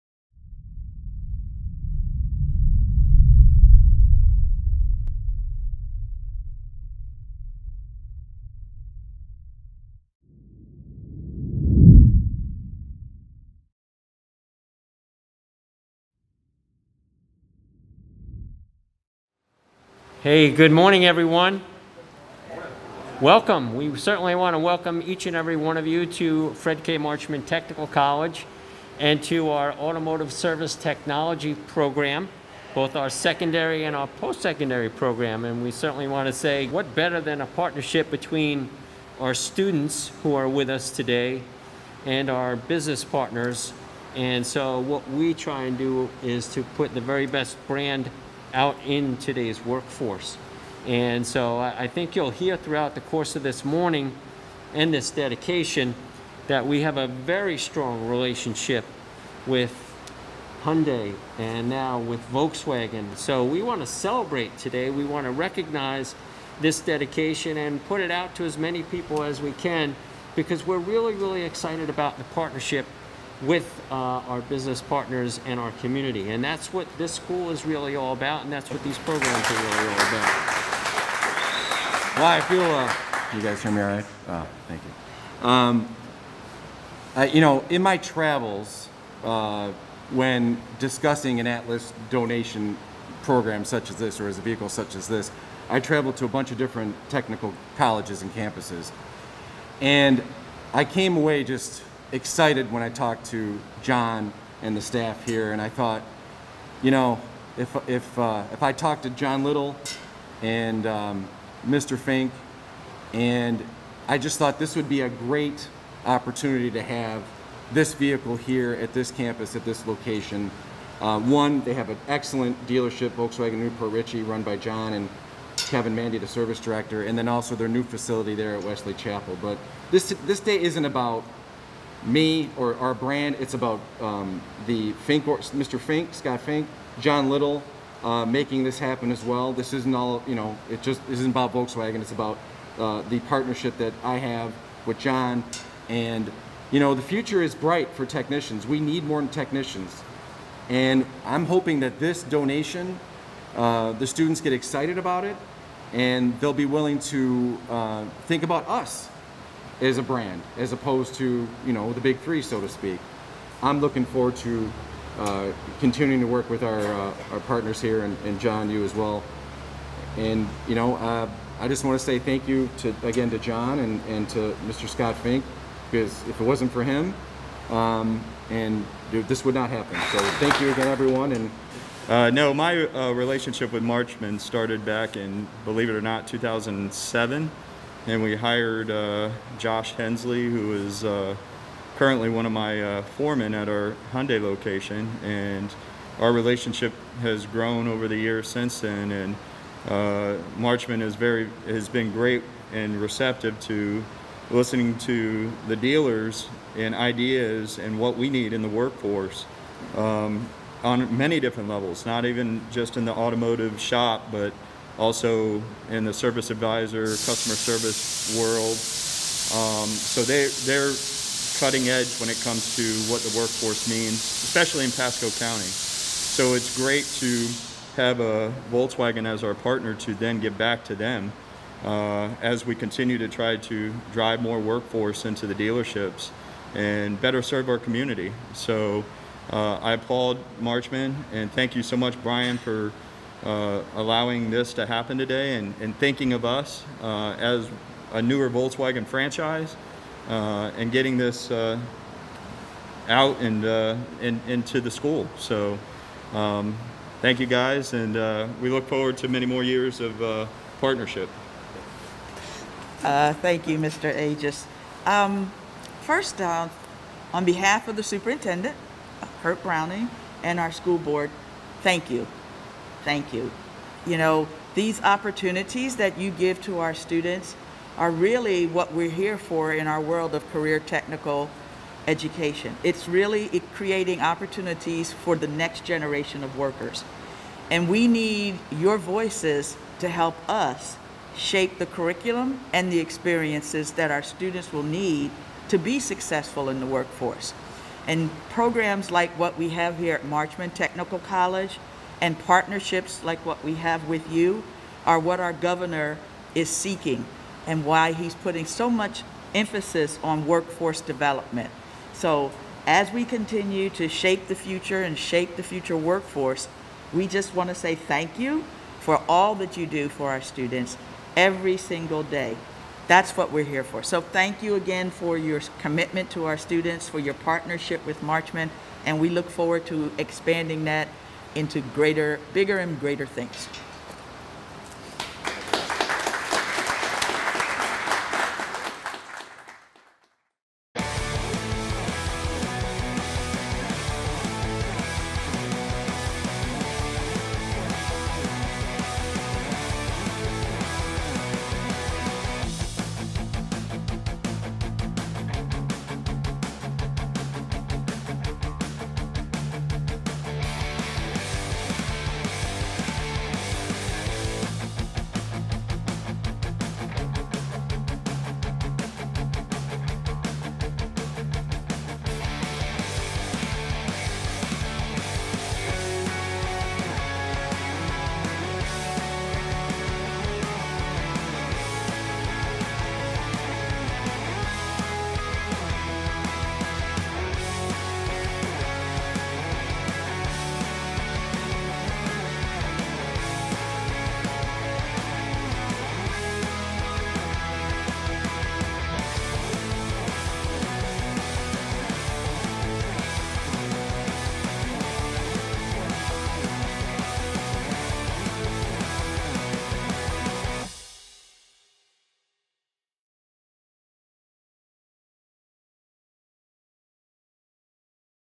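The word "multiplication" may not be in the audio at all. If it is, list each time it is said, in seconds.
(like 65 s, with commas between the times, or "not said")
not said.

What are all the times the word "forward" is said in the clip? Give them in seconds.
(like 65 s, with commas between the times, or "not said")
164 s, 258 s, 329 s.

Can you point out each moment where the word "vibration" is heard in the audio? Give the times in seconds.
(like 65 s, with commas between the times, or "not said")
not said.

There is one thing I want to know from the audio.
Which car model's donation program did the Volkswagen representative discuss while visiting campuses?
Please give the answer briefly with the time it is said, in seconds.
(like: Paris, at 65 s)
Atlas, at 91 s.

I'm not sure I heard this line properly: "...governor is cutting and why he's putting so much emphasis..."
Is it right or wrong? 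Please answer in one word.
wrong.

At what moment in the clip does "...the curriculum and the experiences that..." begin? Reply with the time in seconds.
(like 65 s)
291 s.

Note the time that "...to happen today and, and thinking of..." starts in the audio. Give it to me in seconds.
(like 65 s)
244 s.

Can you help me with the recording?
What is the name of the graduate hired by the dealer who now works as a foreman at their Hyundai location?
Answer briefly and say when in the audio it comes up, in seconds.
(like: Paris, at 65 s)
Josh Hensley, at 189 s.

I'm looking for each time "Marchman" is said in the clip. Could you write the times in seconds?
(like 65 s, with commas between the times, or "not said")
26 s, 183 s, 200 s, 240 s, 300 s, 328 s.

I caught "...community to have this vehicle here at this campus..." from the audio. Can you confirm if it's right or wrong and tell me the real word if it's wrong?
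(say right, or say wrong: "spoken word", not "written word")
wrong: "opportunity", not "community".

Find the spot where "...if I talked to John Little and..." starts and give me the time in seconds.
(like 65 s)
108 s.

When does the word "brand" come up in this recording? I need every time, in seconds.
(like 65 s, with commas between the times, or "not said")
47 s, 132 s, 160 s.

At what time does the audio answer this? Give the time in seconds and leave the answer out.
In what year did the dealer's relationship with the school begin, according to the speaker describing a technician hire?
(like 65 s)
186 s.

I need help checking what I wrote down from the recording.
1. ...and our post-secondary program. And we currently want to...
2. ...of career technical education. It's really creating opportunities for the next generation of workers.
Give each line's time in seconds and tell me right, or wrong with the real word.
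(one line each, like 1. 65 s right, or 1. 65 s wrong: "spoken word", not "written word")
1. 33 s wrong: "certainly", not "currently"
2. 280 s right.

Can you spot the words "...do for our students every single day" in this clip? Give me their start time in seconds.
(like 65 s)
319 s.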